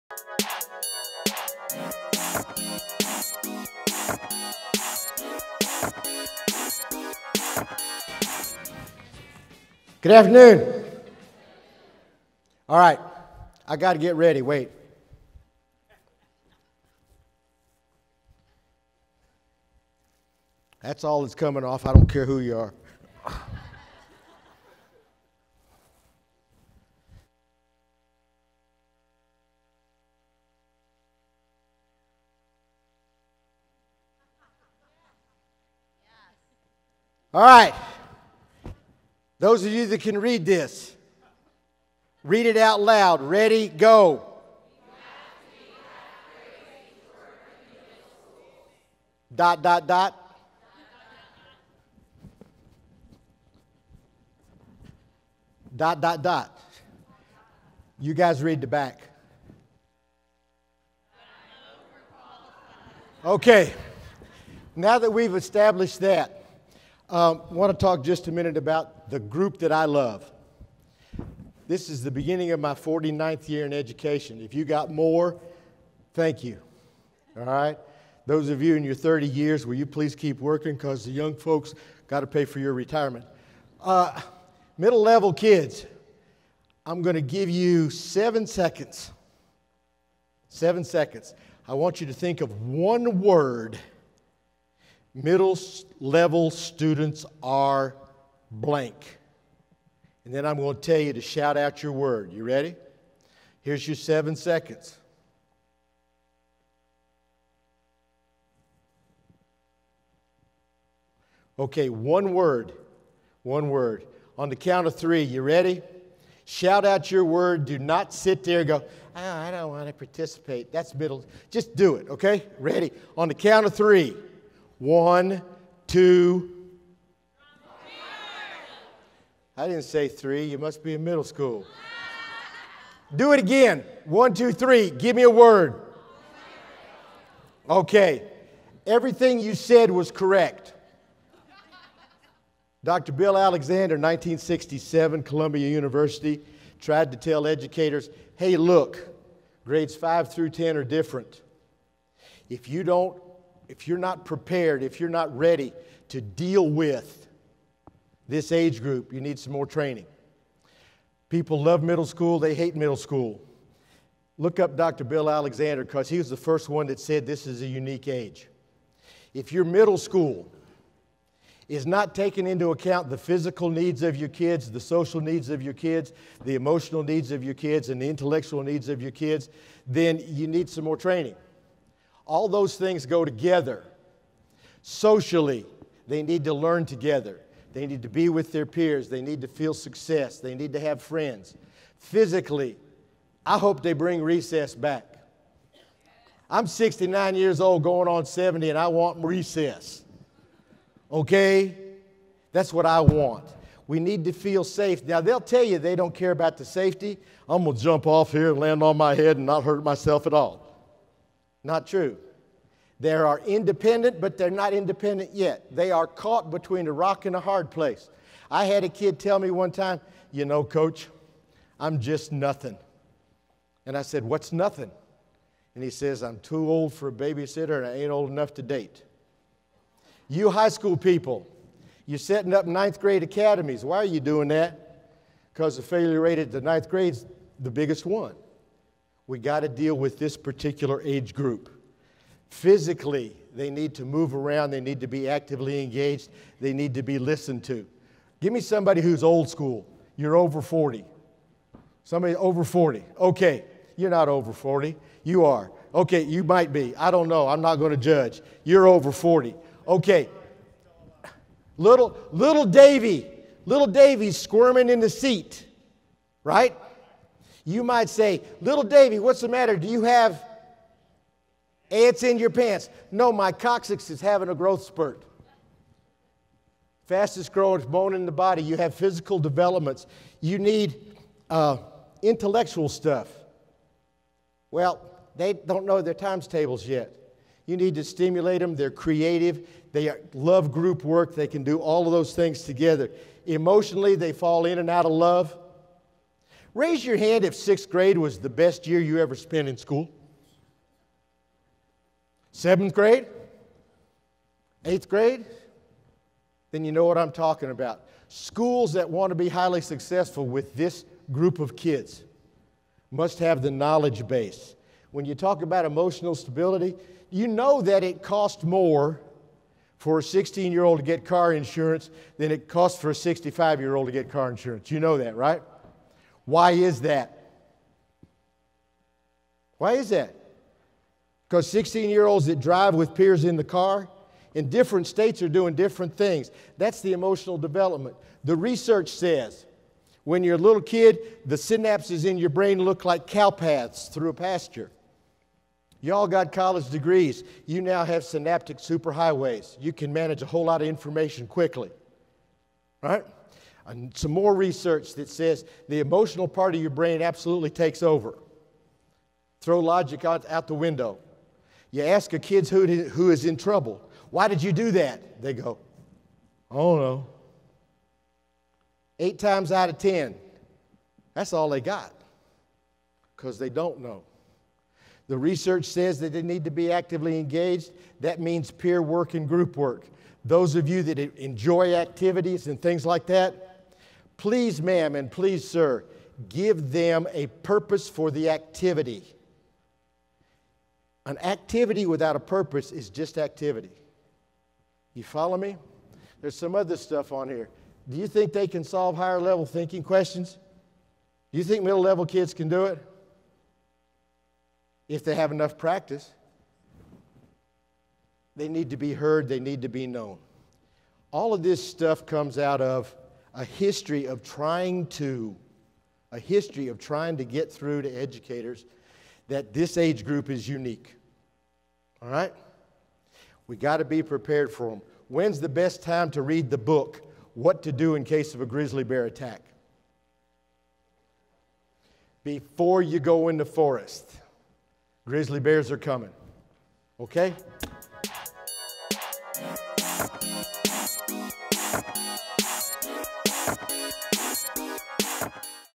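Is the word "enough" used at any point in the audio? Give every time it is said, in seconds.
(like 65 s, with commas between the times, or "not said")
228 s, 405 s.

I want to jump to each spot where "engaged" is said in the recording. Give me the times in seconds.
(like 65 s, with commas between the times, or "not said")
245 s, 377 s.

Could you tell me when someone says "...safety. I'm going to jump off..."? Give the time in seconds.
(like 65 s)
206 s.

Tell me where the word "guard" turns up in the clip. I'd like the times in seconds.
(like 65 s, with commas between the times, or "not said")
not said.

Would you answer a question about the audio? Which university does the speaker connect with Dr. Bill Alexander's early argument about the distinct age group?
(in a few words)
Columbia University.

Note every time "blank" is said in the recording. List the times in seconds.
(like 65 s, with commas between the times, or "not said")
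98 s.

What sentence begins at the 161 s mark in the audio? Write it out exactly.
People love middle school, they hate middle school.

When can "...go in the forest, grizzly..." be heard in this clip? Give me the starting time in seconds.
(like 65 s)
433 s.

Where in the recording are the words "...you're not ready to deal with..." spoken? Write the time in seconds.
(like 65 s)
154 s.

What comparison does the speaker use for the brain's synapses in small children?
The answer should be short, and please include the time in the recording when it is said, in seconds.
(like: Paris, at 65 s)
cow paths, at 343 s.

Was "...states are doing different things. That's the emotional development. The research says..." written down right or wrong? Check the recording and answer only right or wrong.
right.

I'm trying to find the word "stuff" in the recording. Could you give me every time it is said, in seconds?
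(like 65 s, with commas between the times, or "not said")
282 s, 396 s, 411 s.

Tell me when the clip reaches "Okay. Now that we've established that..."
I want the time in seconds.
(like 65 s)
63 s.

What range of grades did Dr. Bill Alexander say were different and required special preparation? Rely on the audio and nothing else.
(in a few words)
5 through 10.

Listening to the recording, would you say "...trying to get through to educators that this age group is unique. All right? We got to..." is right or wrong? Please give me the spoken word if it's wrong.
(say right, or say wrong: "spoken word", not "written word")
right.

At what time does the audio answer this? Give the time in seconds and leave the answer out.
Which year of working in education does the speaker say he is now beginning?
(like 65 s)
72 s.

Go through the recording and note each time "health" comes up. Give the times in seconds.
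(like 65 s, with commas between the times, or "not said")
not said.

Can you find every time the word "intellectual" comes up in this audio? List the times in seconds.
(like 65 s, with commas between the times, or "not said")
178 s, 282 s.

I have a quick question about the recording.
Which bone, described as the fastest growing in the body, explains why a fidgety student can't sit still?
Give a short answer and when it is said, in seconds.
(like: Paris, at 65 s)
coccyx, at 273 s.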